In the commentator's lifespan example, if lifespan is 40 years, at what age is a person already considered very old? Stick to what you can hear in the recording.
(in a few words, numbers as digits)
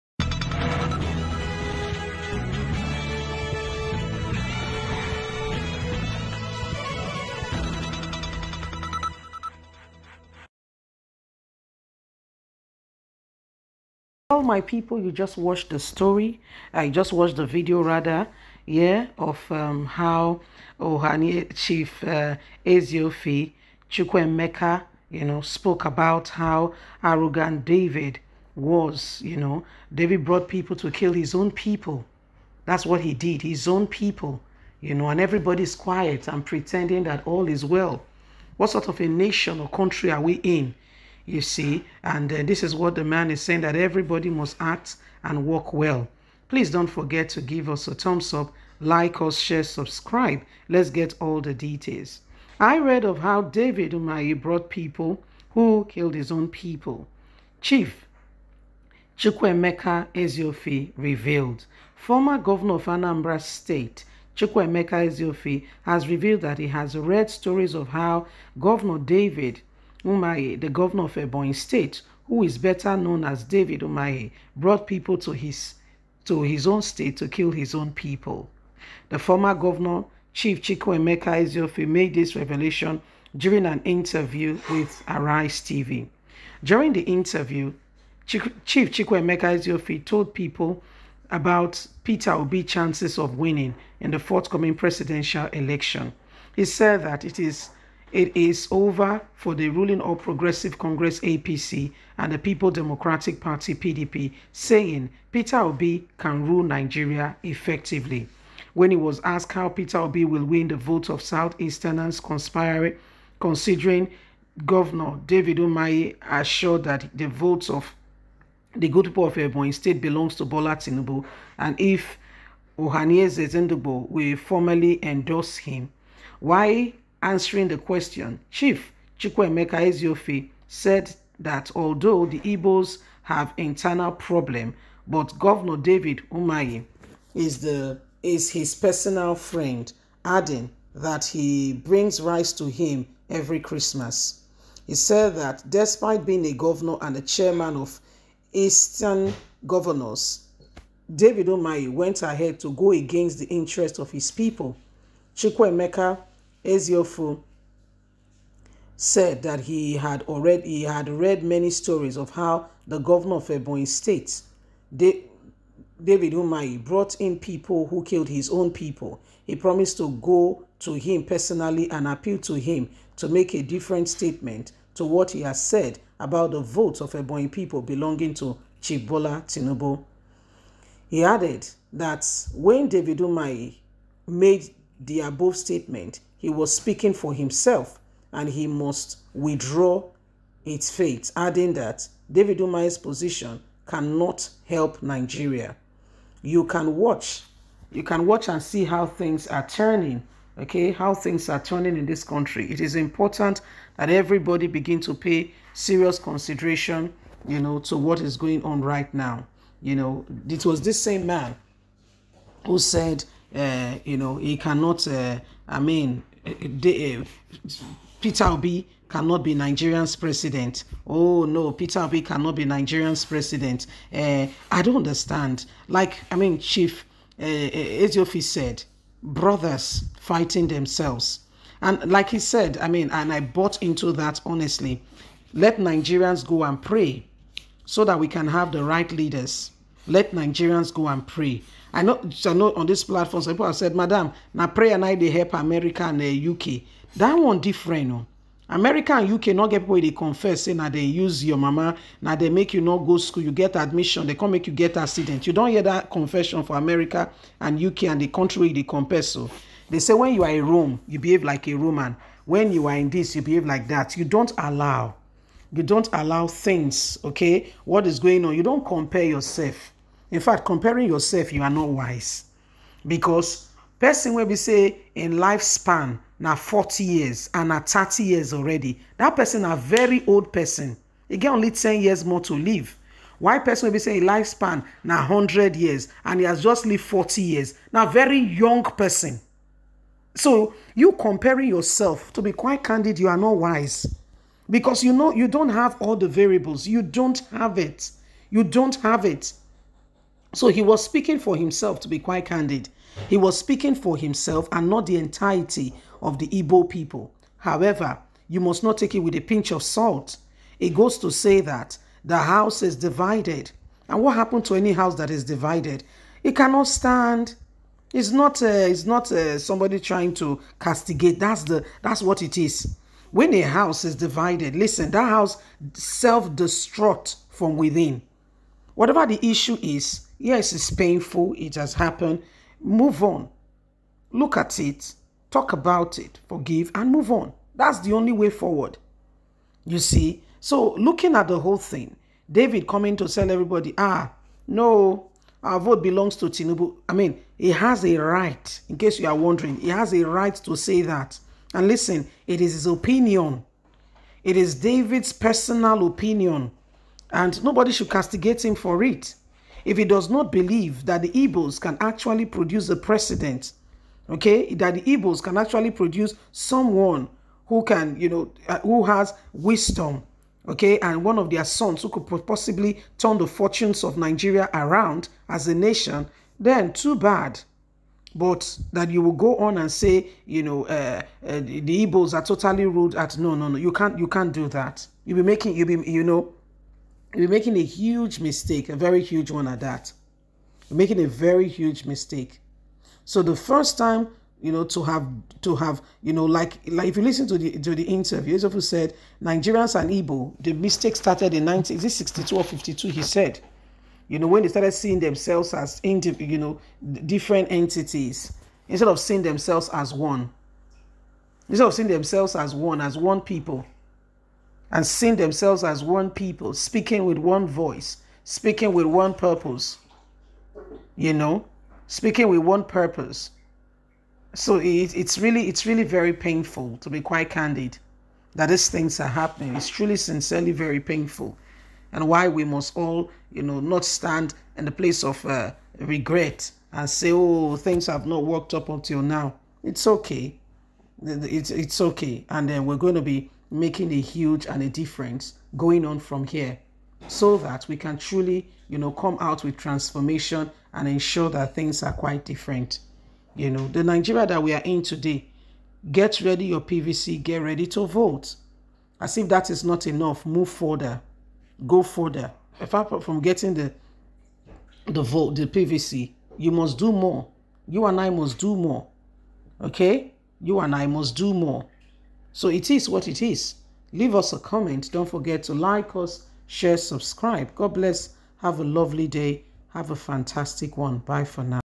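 30.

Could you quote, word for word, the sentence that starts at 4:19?
They say when you are a Rome, you behave like a Roman.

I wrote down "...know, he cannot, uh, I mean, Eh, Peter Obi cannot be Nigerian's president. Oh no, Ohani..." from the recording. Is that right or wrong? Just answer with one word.
wrong.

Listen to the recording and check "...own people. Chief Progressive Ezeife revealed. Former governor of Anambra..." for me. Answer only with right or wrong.
wrong.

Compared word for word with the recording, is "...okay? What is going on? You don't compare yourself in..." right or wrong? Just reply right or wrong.
right.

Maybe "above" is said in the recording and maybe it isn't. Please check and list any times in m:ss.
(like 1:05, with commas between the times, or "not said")
3:05.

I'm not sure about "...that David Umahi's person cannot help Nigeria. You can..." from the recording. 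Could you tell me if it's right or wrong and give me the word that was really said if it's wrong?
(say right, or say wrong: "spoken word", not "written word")
wrong: "position", not "person".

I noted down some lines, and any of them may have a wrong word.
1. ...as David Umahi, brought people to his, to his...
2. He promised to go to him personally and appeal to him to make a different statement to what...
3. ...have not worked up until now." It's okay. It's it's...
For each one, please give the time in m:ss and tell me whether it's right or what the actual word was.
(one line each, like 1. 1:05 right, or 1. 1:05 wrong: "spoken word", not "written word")
1. 1:13 right
2. 2:49 right
3. 7:18 right.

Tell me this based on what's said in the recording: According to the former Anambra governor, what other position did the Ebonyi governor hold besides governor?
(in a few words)
Chairman of Eastern governors.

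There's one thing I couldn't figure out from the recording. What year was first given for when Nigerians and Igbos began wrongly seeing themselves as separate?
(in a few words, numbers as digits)
1962.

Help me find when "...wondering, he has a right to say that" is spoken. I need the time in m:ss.
5:49.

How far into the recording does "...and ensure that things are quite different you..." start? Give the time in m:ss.
7:30.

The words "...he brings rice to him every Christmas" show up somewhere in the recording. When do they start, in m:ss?
2:21.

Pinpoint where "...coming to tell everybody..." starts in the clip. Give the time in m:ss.
5:42.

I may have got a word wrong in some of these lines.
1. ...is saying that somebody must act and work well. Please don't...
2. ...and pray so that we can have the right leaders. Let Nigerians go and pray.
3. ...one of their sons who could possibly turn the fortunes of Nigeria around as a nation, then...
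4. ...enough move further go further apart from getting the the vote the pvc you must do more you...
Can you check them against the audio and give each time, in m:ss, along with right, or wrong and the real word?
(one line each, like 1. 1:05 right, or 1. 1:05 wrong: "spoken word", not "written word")
1. 0:43 wrong: "everybody", not "somebody"
2. 3:56 right
3. 6:11 right
4. 7:40 right.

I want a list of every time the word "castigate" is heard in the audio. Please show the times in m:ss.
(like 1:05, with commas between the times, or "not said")
5:20, 5:58.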